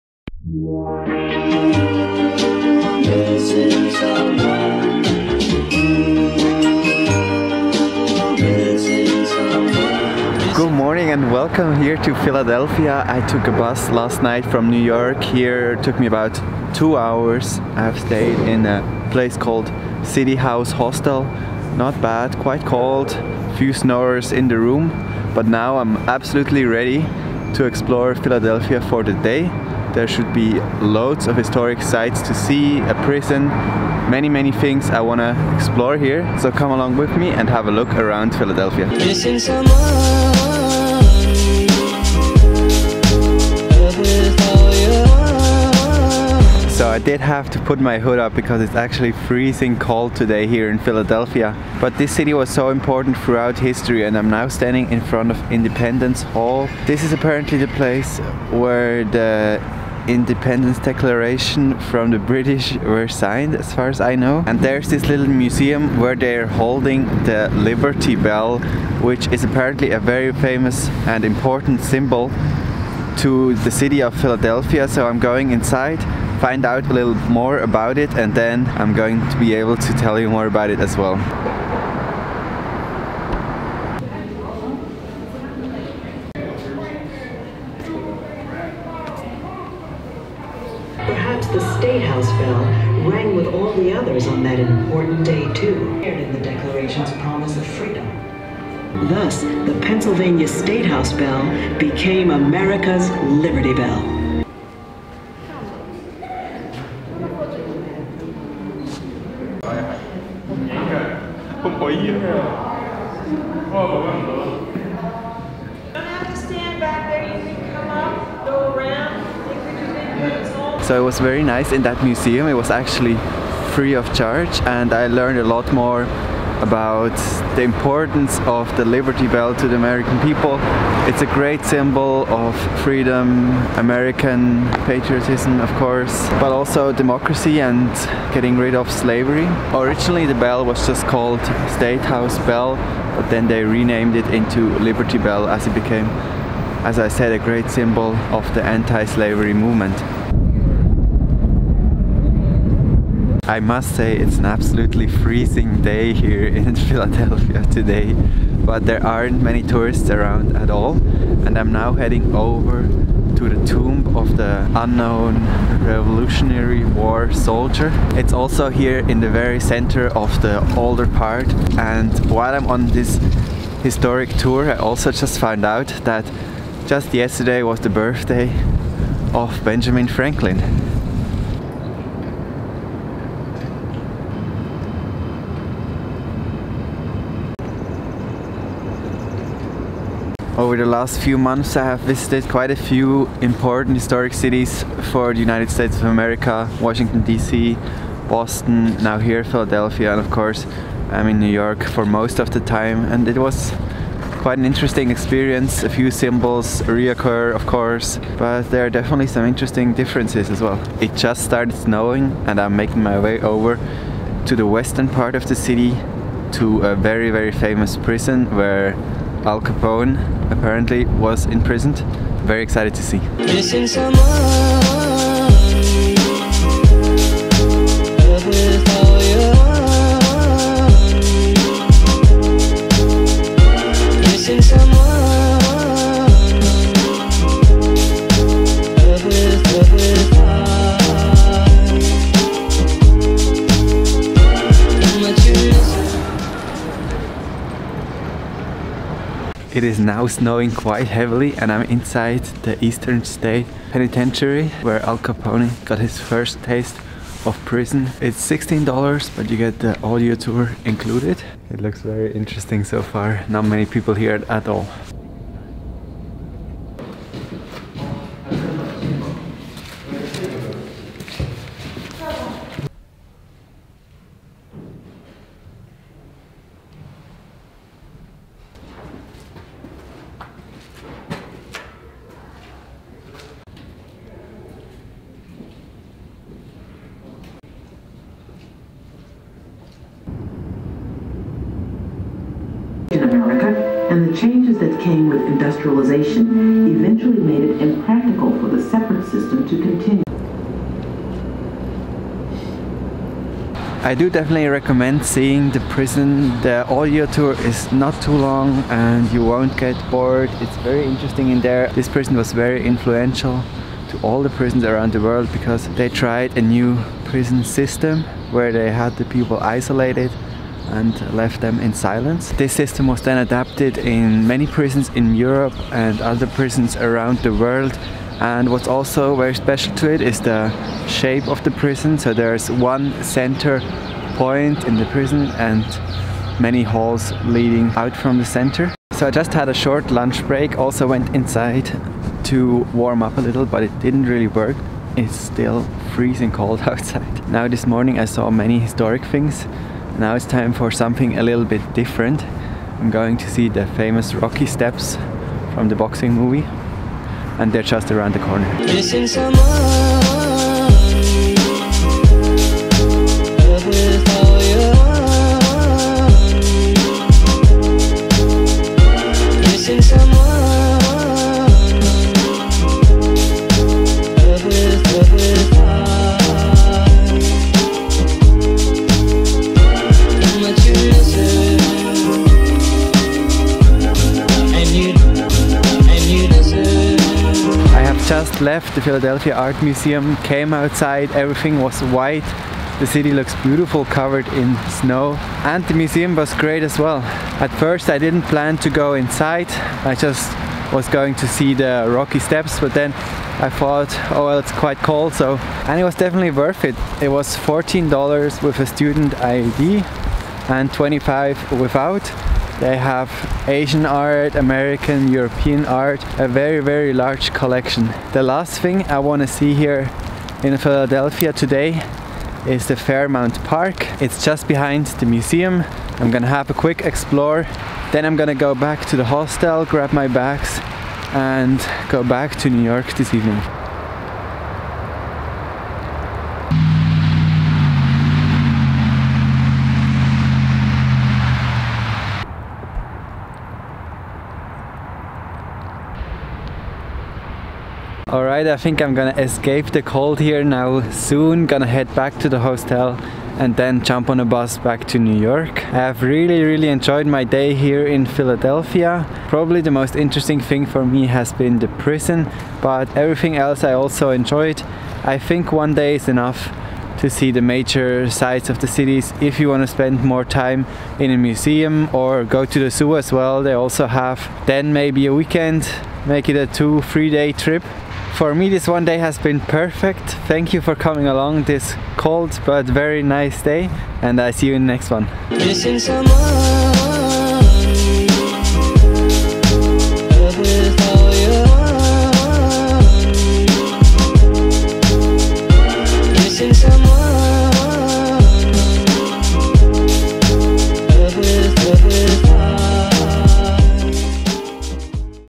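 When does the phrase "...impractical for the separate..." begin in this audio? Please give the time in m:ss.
4:57.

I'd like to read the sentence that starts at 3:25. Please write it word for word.
A few symbols reoccur of course, but there are definitely some interesting differences as well.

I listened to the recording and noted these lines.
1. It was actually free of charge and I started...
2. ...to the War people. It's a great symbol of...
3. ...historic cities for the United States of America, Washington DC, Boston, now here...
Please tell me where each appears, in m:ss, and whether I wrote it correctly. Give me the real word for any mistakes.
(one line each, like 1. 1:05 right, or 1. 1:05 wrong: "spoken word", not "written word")
1. 2:02 wrong: "learned", not "started"
2. 2:09 wrong: "American", not "War"
3. 3:13 right.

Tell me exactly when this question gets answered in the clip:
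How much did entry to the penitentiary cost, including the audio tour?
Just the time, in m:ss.
4:18.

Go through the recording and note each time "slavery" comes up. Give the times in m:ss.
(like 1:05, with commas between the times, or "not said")
2:18, 2:29.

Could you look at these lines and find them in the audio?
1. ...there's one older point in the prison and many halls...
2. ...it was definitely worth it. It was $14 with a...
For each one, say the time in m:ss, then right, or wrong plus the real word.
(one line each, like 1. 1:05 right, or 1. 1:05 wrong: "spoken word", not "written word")
1. 5:32 wrong: "center", not "older"
2. 6:45 right.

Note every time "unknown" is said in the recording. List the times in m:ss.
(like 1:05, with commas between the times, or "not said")
2:44.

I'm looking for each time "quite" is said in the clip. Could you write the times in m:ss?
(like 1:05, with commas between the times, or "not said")
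0:22, 3:12, 3:24, 4:10, 6:44.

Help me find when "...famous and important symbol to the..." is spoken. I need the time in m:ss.
1:10.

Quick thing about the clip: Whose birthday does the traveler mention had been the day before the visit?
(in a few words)
Benjamin Franklin.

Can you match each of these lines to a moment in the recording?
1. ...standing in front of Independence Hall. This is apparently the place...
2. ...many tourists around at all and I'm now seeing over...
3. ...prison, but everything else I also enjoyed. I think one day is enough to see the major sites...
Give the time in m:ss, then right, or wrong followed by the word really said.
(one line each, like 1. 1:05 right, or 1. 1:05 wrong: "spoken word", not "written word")
1. 0:54 right
2. 2:39 wrong: "heading", not "seeing"
3. 7:41 right.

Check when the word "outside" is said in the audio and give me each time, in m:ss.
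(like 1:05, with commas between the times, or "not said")
5:46, 6:30.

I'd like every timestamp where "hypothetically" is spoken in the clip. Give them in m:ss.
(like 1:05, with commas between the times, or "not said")
not said.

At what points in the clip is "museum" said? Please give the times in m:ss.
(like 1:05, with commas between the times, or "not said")
1:05, 2:02, 6:29, 6:35, 7:05, 7:51.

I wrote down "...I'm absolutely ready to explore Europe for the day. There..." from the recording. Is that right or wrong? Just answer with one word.
wrong.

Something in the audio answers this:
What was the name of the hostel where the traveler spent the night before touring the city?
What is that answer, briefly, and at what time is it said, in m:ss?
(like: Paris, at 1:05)
City House Hostel, at 0:20.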